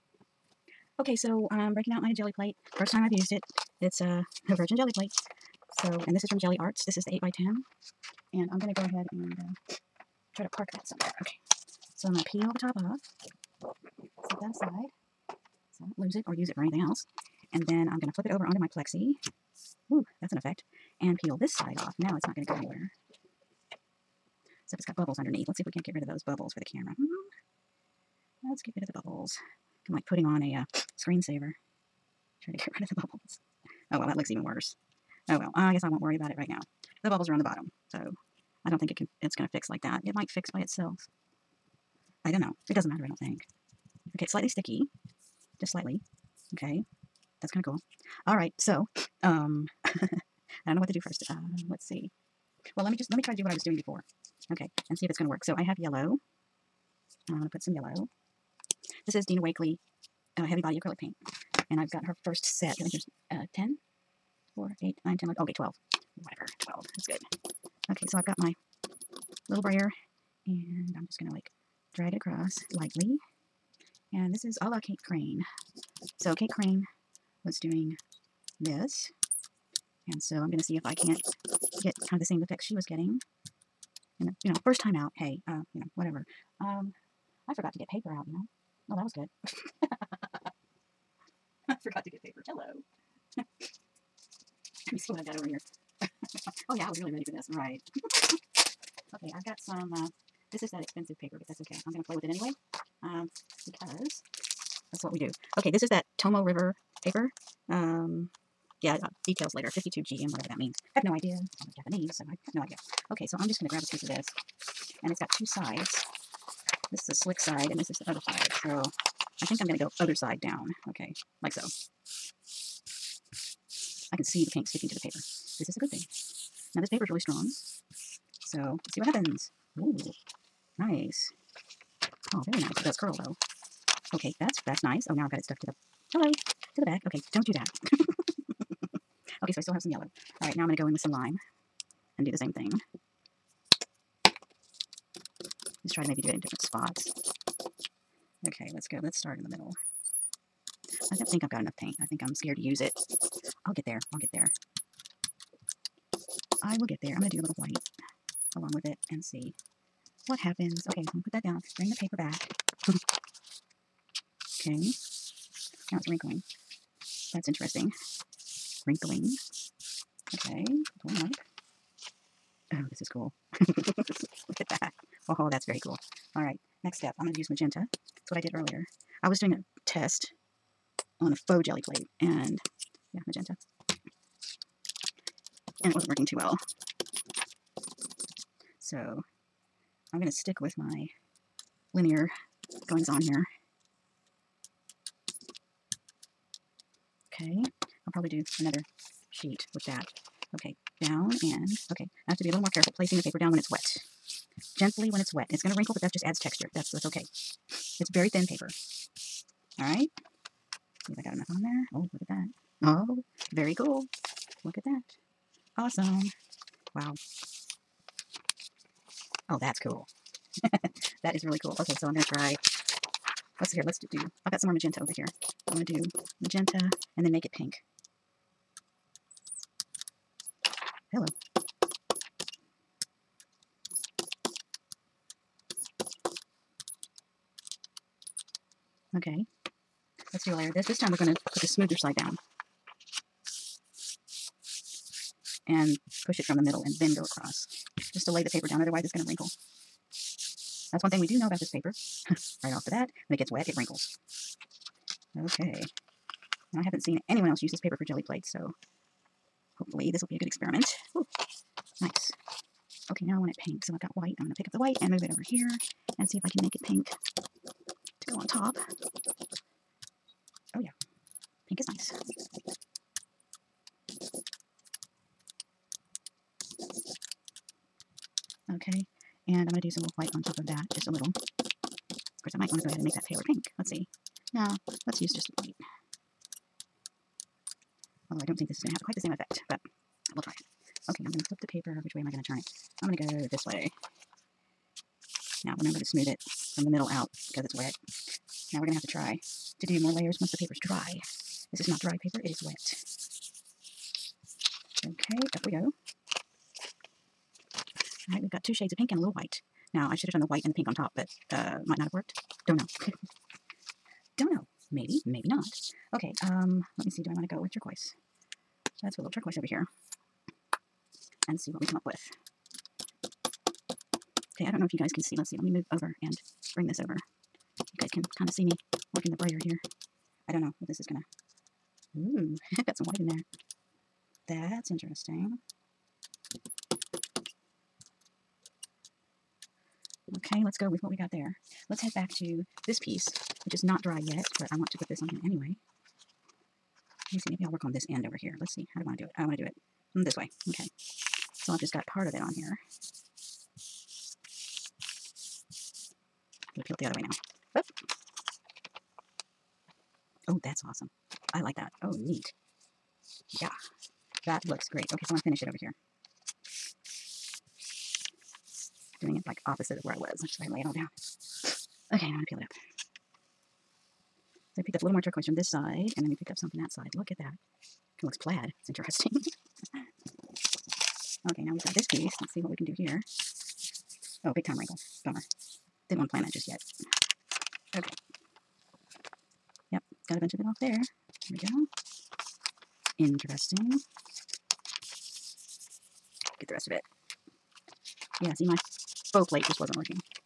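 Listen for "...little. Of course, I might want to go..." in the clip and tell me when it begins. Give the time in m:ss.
4:41.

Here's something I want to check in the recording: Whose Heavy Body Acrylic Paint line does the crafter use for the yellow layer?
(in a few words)
Dina Wakley.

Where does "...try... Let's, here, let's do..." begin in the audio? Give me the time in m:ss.
3:42.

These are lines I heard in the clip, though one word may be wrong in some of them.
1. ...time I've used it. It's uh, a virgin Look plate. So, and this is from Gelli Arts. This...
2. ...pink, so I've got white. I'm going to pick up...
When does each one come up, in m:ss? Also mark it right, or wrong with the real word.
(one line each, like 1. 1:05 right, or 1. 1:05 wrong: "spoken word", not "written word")
1. 0:02 wrong: "Gelli", not "Look"
2. 4:23 right.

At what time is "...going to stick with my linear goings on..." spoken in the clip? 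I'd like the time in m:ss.
3:10.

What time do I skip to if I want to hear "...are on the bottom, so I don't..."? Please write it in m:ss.
0:37.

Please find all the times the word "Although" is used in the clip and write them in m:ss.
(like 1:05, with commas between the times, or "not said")
4:48.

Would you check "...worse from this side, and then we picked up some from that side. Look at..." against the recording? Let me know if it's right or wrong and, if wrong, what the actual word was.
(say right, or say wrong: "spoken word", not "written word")
wrong: "turquoise", not "worse".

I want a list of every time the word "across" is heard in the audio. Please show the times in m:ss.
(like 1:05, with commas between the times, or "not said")
1:12, 4:07.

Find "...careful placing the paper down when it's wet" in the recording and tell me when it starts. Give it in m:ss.
3:22.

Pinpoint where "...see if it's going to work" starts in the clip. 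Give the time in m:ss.
0:54.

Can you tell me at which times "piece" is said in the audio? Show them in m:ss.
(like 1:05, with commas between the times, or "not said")
1:53, 5:42, 6:22.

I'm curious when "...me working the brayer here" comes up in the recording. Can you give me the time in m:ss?
5:28.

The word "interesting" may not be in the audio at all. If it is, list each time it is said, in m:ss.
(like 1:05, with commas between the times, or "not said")
2:47, 5:34, 6:18, 6:33.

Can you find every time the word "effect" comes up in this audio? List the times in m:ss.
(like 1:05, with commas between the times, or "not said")
0:20, 1:22, 4:49.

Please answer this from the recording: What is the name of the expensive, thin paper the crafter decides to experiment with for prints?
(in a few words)
Tomoe River.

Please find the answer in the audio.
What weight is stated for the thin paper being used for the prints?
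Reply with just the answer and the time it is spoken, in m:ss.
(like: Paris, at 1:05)
52 GM, at 1:49.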